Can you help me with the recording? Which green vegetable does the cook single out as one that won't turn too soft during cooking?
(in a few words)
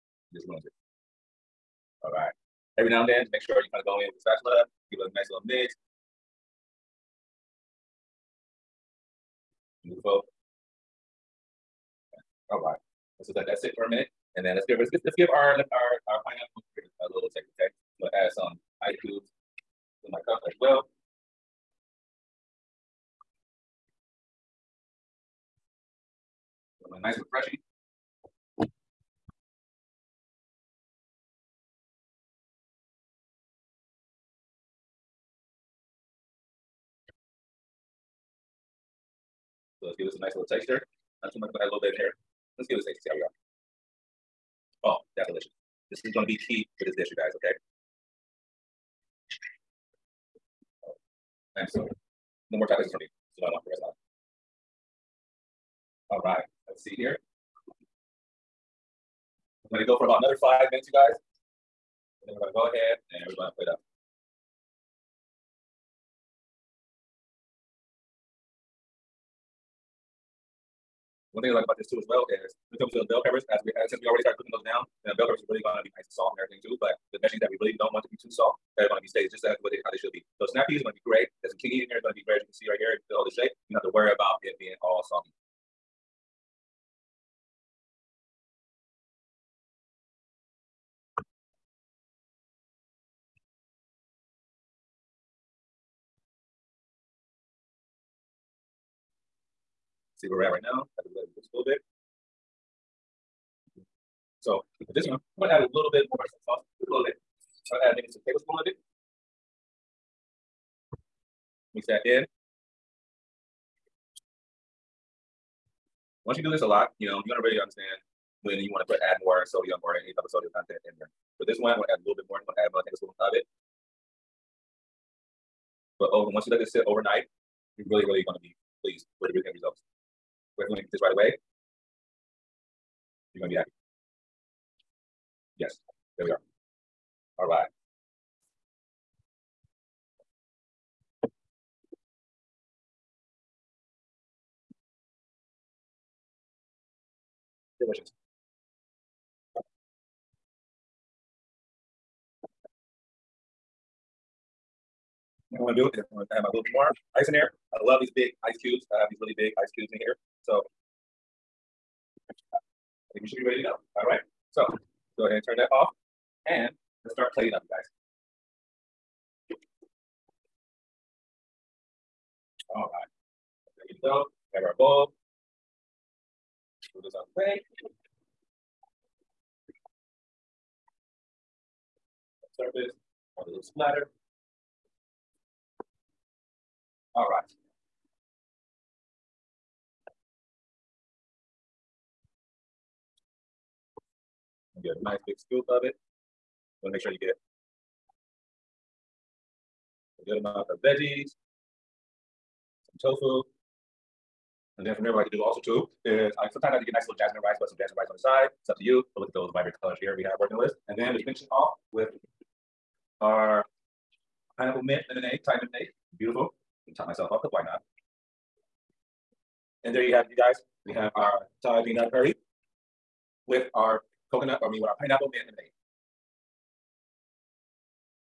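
Snap peas.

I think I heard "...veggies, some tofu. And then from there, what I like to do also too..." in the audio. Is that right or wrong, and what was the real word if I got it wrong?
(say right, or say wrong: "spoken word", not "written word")
right.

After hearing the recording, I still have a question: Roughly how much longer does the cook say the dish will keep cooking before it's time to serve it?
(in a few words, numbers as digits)
5 minutes.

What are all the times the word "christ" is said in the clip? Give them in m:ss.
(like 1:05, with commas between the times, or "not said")
not said.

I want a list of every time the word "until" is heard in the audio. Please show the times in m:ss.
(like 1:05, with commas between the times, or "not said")
1:12.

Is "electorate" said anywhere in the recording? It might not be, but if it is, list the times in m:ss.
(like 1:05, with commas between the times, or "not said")
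not said.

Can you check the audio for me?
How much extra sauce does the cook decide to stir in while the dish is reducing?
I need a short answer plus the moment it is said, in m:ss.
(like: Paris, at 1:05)
1 tablespoon, at 2:02.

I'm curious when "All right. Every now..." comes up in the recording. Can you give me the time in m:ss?
0:02.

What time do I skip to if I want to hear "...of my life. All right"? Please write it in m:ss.
0:53.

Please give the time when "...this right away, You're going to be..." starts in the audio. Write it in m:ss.
2:10.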